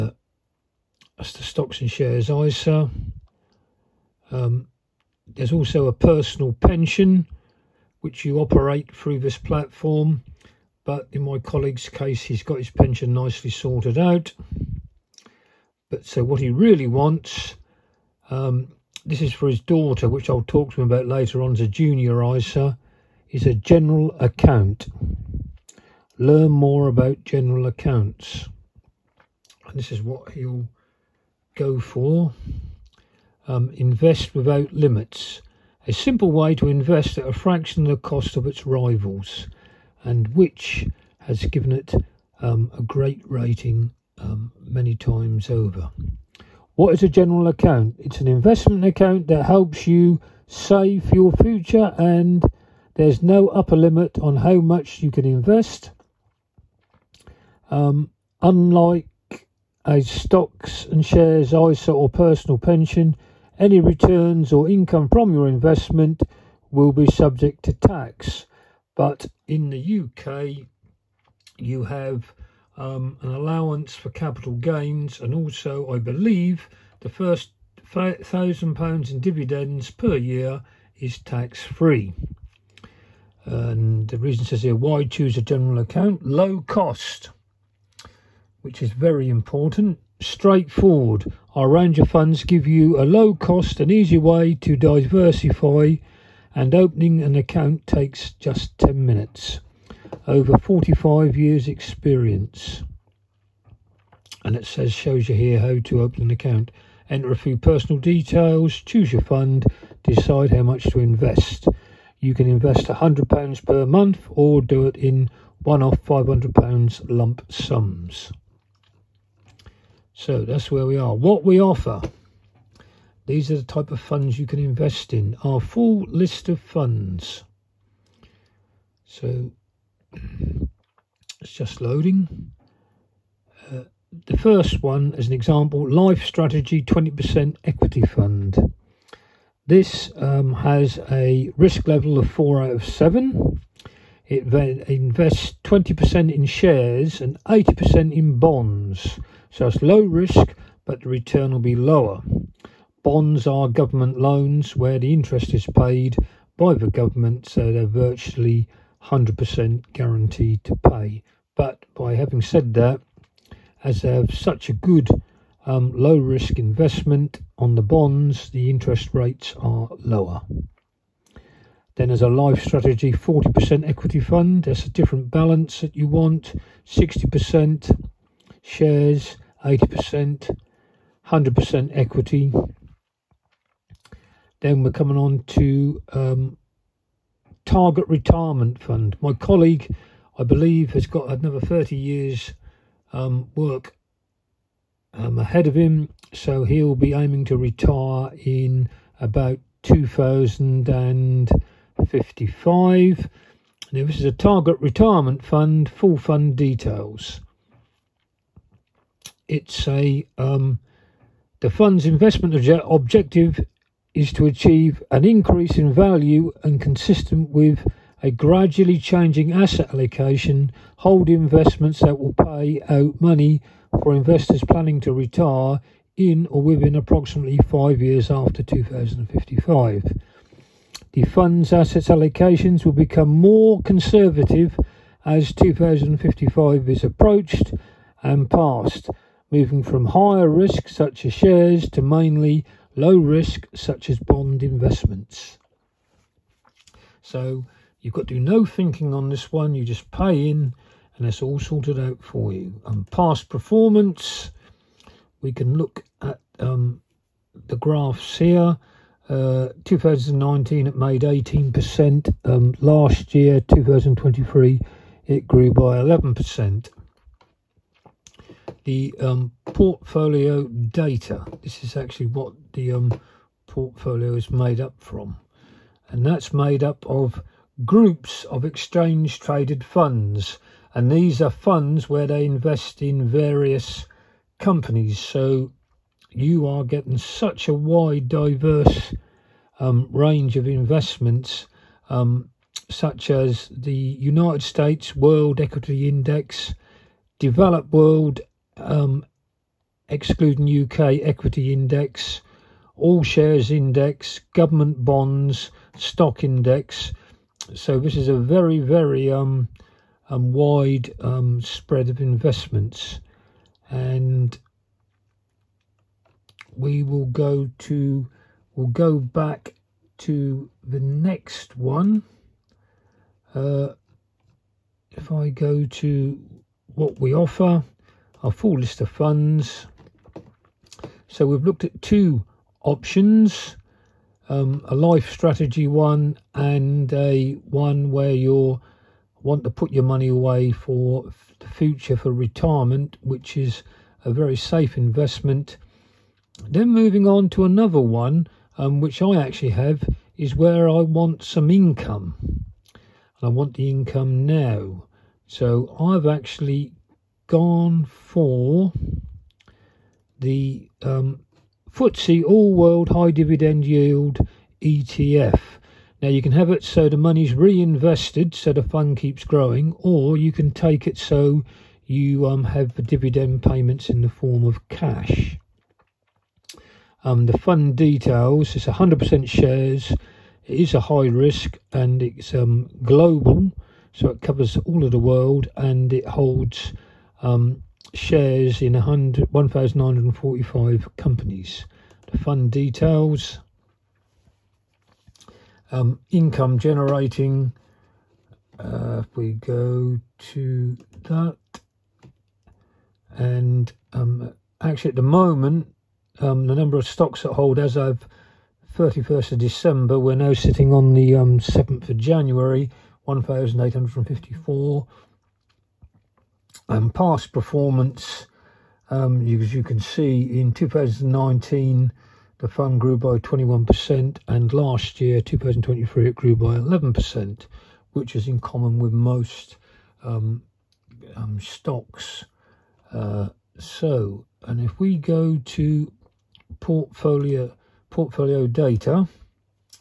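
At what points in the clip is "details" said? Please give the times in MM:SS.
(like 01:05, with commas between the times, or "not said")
01:48, 03:26, 06:17, 06:32.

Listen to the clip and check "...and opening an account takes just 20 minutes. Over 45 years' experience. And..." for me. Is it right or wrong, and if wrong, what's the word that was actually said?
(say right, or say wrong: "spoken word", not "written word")
wrong: "10", not "20".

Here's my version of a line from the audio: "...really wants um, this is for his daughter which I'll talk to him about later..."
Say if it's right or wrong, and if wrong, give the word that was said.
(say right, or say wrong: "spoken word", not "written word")
right.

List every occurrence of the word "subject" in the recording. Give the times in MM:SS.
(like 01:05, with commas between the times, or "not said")
01:07.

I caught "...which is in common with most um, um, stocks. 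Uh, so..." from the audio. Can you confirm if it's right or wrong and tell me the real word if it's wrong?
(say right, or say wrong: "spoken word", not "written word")
right.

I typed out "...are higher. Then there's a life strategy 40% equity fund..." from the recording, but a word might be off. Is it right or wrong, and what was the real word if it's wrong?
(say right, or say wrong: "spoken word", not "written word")
wrong: "lower", not "higher".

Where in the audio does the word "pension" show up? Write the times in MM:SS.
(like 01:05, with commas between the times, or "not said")
00:06, 00:12, 01:02.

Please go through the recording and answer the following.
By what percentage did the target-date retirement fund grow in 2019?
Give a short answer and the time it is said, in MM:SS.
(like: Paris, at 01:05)
18%, at 04:21.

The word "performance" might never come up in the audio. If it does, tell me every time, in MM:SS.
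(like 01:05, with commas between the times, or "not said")
04:13, 06:57.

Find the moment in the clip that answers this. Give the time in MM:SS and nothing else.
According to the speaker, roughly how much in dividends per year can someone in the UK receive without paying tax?
01:17.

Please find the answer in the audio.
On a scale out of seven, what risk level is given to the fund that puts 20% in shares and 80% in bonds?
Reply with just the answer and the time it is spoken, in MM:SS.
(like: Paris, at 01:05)
4, at 02:22.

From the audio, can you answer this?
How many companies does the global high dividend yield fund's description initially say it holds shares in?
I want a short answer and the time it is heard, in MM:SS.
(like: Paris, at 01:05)
1,945, at 06:28.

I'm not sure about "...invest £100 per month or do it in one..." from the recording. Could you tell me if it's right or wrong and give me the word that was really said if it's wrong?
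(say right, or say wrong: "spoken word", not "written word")
right.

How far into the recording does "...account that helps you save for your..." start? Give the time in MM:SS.
00:48.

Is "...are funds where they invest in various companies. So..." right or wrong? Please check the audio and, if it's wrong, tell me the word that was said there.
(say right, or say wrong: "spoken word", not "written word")
right.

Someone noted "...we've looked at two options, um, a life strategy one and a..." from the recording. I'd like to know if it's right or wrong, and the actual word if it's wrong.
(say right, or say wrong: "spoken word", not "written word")
right.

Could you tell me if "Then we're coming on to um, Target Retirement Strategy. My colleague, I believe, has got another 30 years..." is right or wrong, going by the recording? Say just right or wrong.
wrong.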